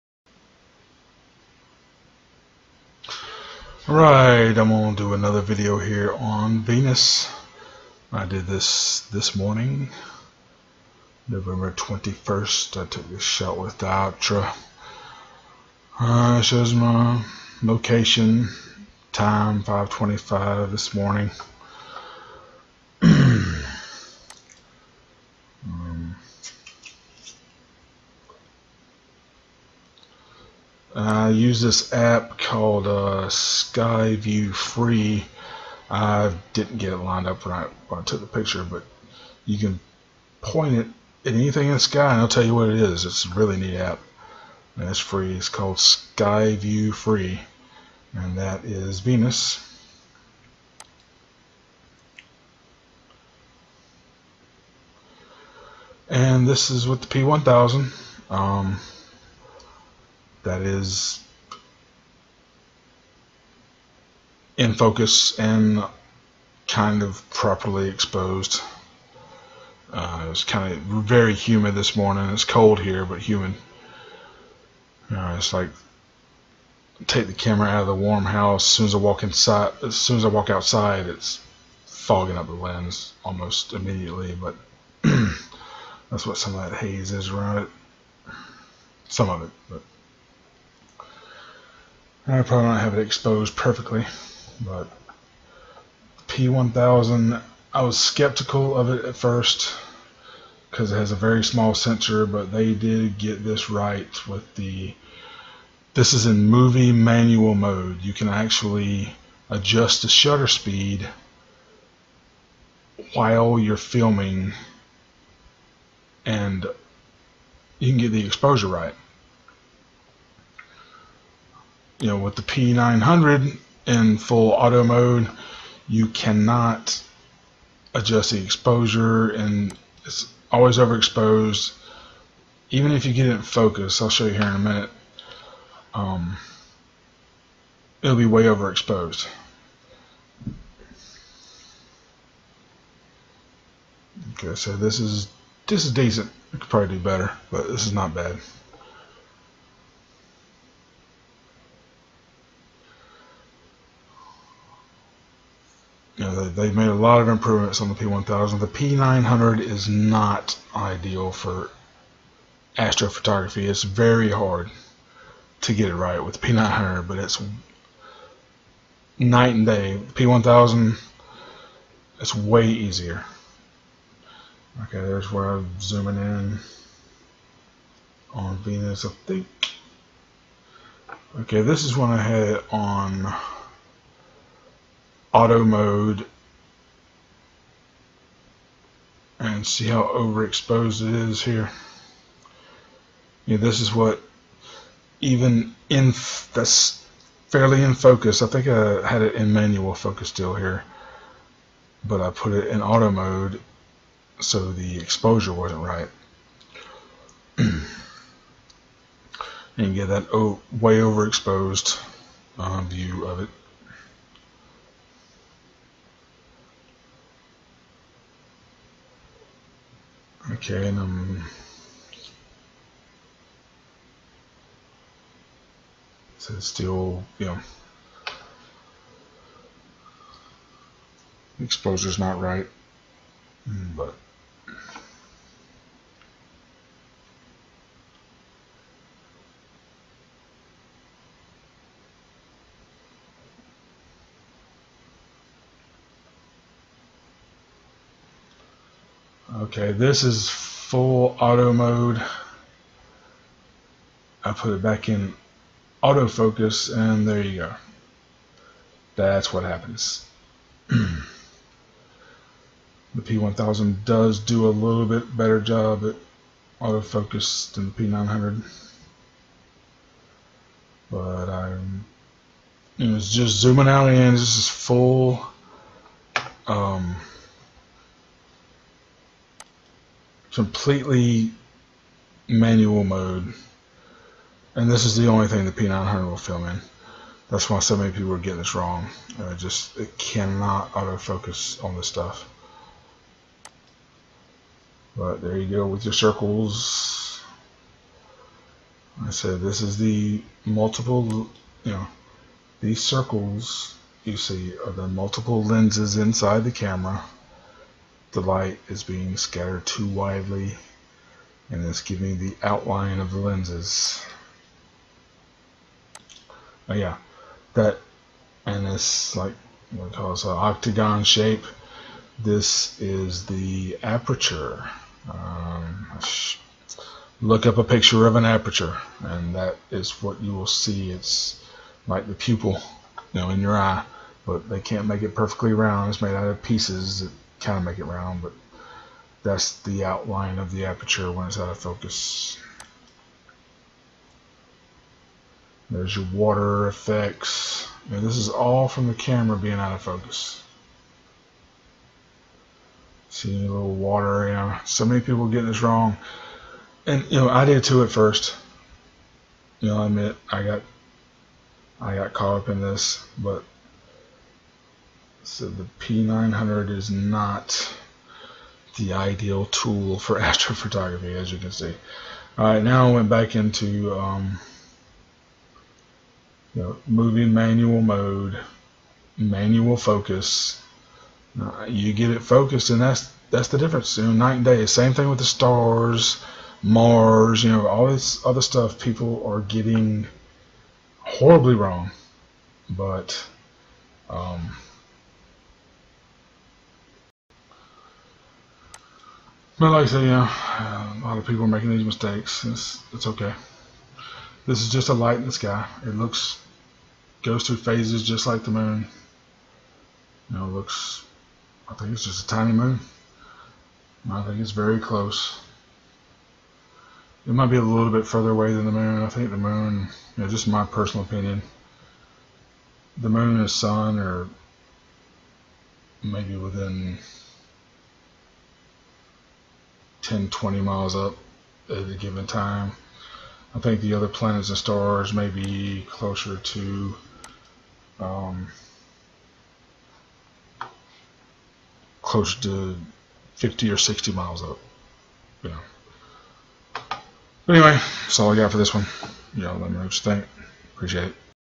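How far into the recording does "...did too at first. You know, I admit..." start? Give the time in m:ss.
5:57.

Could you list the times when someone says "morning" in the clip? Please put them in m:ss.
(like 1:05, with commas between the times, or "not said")
0:09, 0:20, 1:11.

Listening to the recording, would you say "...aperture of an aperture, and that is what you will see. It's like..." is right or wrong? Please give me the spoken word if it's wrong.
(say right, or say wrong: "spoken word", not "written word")
wrong: "picture", not "aperture".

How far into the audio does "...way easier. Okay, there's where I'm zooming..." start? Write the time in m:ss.
2:52.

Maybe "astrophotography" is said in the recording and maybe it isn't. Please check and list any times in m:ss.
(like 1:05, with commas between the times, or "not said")
2:42, 6:10.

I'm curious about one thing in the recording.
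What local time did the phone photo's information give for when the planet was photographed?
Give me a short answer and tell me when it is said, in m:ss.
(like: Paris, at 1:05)
5:25, at 0:19.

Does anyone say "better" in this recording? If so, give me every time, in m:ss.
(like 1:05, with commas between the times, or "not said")
2:27, 4:25.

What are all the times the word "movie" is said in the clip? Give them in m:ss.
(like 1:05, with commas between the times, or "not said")
1:46, 6:17.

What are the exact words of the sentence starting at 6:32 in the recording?
But um, But like I say, you know, a lot of people are making these mistakes.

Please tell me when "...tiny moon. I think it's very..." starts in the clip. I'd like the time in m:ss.
6:52.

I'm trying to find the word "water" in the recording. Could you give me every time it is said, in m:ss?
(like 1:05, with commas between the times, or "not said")
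5:46, 5:53.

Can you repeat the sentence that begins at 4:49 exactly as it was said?
Uh, just it cannot autofocus on this stuff.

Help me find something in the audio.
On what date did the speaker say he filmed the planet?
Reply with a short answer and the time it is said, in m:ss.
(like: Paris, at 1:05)
November 21st, at 0:11.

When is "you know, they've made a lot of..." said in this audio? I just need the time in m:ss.
2:36.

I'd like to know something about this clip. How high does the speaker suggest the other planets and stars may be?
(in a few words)
50 or 60 miles.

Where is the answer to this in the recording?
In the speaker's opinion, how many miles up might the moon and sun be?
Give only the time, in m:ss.
7:10.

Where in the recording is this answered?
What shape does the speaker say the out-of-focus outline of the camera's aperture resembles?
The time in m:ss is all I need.
5:20.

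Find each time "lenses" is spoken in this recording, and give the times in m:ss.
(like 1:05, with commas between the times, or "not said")
5:05, 5:13.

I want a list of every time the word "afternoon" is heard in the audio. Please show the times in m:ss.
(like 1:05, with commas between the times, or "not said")
not said.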